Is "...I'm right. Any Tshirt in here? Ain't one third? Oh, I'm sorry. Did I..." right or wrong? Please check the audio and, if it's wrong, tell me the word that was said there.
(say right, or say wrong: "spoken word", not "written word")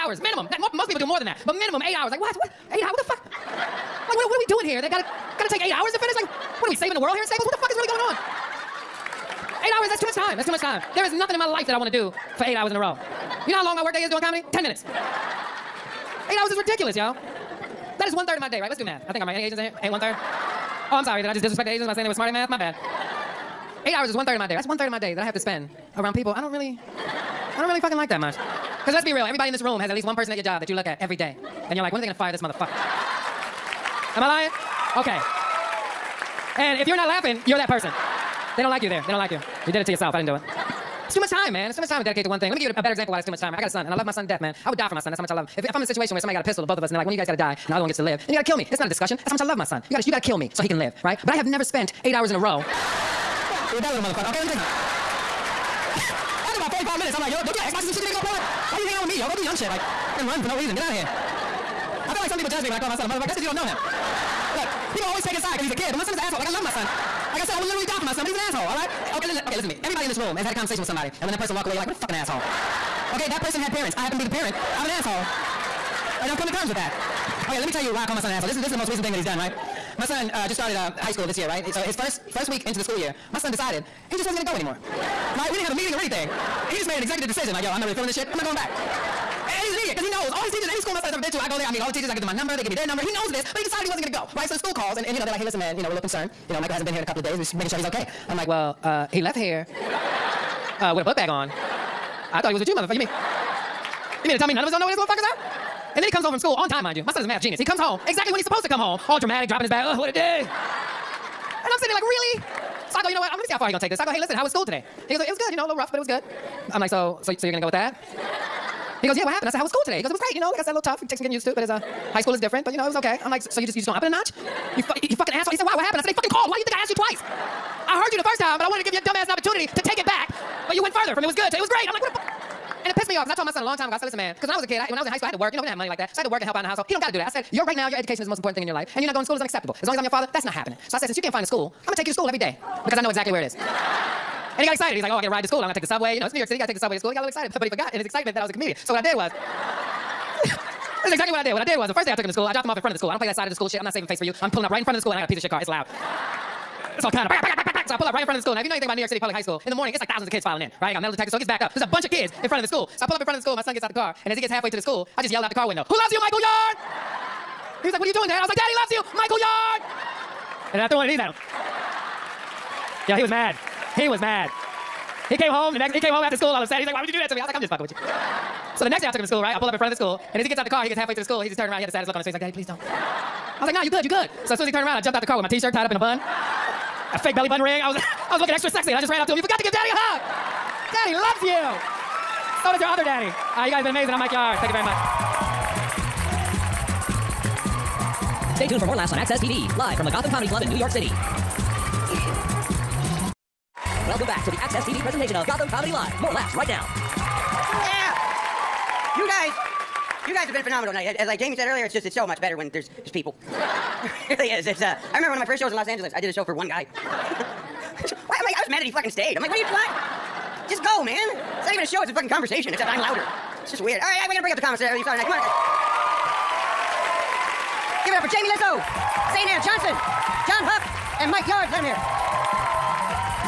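wrong: "Asians", not "Tshirt".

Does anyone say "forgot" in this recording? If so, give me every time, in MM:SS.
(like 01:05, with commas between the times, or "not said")
02:27, 03:09.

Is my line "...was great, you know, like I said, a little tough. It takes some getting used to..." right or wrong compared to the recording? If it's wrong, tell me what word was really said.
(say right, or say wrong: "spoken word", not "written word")
right.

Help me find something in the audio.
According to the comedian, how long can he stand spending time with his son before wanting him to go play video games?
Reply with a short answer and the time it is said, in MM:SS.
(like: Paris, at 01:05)
45 minutes, at 00:56.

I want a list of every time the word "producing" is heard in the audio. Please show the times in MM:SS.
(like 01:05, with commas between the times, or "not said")
not said.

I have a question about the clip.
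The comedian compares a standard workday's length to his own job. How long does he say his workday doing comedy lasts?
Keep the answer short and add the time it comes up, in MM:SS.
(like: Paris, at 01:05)
10 minutes, at 00:14.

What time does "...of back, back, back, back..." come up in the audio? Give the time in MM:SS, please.
02:37.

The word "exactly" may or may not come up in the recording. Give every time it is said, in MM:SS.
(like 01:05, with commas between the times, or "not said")
01:48, 02:23, 02:31.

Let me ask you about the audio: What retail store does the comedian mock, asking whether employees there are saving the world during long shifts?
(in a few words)
Staples.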